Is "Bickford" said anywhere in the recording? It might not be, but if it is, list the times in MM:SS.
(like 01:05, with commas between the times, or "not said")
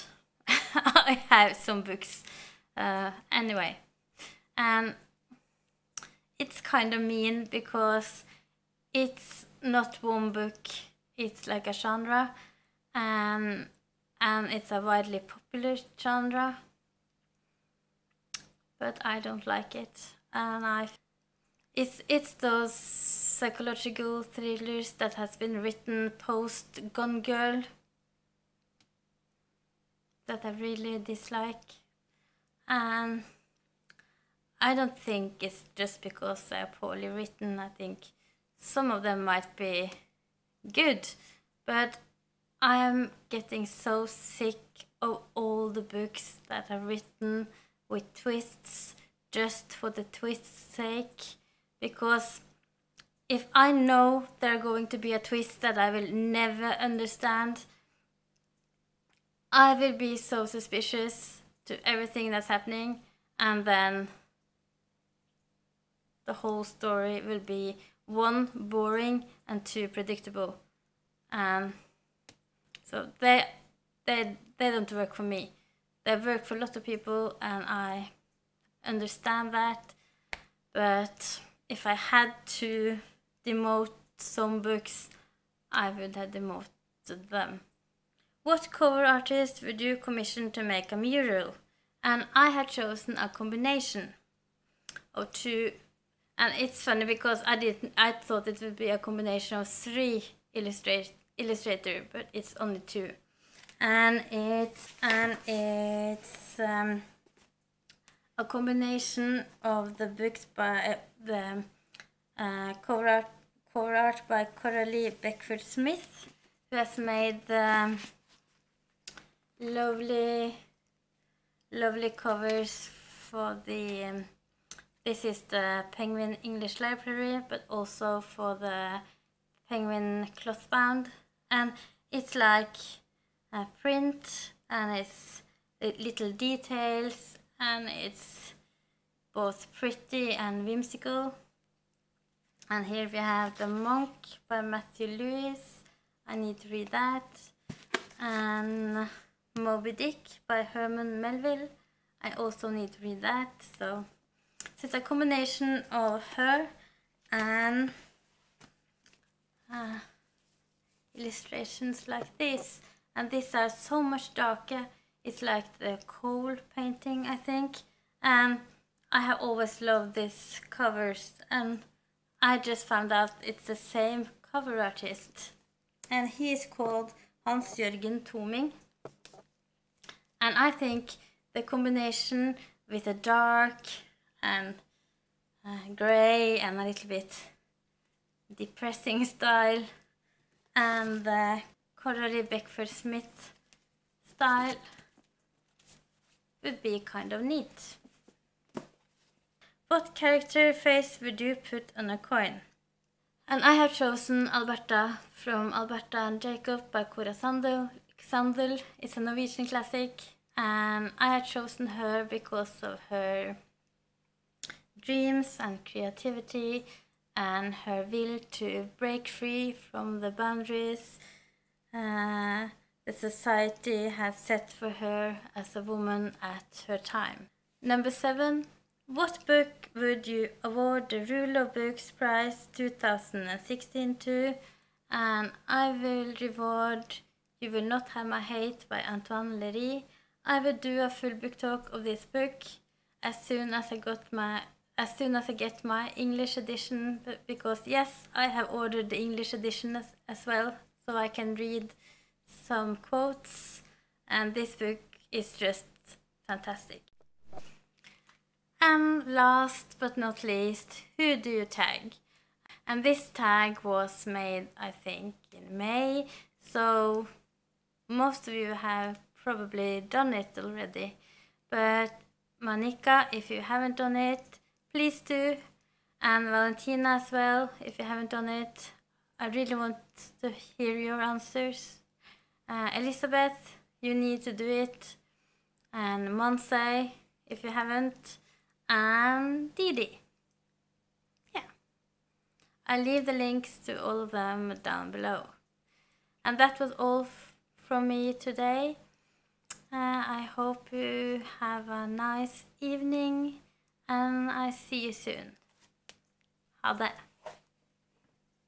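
01:55, 03:12.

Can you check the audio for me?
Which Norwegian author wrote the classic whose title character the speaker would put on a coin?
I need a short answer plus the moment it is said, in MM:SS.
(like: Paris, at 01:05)
Cora Sandel, at 03:27.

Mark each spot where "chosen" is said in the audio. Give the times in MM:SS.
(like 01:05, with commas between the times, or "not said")
01:32, 03:23, 03:31.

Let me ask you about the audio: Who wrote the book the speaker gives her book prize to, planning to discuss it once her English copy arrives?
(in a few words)
Antoine Leiris.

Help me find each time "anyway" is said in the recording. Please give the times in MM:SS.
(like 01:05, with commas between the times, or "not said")
00:03.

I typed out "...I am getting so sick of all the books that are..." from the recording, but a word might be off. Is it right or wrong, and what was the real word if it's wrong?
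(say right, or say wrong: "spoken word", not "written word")
right.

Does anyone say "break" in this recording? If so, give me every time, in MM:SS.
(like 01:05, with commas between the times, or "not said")
03:38.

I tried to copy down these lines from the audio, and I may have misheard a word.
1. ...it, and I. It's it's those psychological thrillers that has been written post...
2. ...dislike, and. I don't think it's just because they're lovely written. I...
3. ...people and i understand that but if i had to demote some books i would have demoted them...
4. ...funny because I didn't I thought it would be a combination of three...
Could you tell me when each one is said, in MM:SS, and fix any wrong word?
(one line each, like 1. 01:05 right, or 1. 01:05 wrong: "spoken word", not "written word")
1. 00:19 right
2. 00:30 wrong: "poorly", not "lovely"
3. 01:16 right
4. 01:36 right.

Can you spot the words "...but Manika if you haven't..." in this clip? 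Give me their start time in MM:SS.
04:31.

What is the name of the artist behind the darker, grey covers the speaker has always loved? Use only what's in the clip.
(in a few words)
Hans Jørgen Toming.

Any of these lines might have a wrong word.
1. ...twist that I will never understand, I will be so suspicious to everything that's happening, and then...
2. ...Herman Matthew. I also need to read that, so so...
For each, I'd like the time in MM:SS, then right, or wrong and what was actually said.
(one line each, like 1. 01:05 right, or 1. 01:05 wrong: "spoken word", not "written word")
1. 00:55 right
2. 02:30 wrong: "Melville", not "Matthew".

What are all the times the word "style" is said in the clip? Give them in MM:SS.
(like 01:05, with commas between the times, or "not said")
03:09, 03:14.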